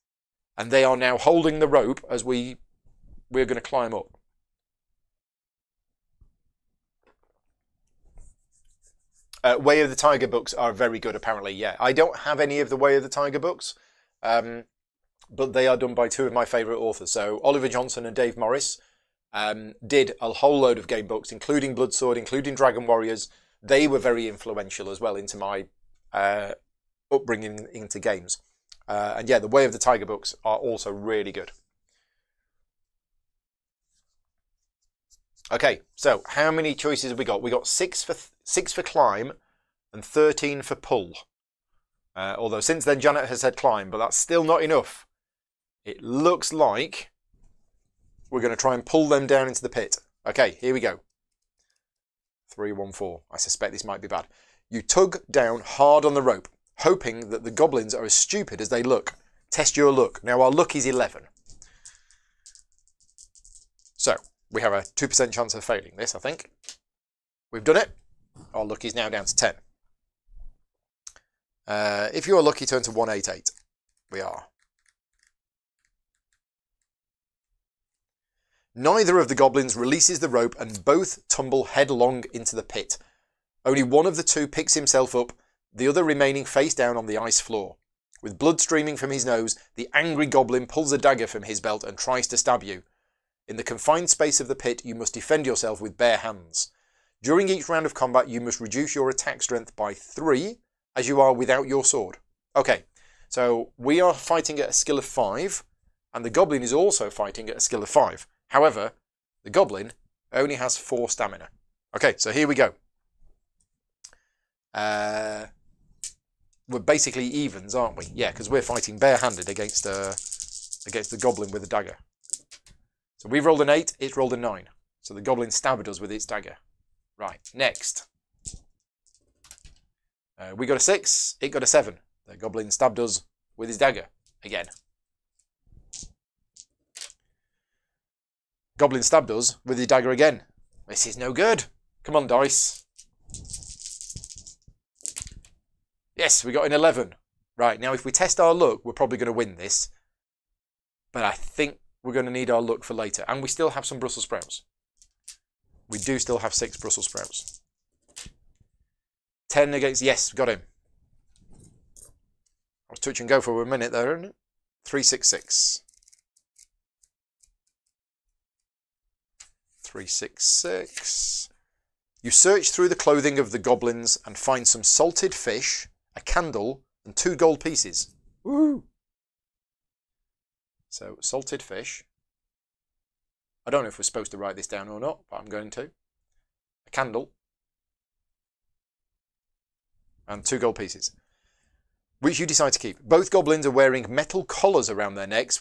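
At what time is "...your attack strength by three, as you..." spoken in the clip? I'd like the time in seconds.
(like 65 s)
98 s.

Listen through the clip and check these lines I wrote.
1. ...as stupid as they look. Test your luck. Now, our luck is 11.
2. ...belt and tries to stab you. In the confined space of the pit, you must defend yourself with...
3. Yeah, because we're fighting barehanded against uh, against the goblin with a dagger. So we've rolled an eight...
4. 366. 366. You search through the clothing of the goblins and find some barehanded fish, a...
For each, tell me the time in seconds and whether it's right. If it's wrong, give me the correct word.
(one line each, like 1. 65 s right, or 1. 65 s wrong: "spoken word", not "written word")
1. 58 s right
2. 91 s right
3. 118 s right
4. 164 s wrong: "salted", not "barehanded".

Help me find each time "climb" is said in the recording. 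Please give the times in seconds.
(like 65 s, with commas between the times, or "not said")
3 s, 38 s, 43 s.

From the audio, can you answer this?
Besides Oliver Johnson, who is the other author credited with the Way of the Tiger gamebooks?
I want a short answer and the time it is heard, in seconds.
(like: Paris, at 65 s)
Dave Morris, at 18 s.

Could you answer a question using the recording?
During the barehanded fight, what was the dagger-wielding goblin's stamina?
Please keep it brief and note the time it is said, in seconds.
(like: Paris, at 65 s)
4, at 110 s.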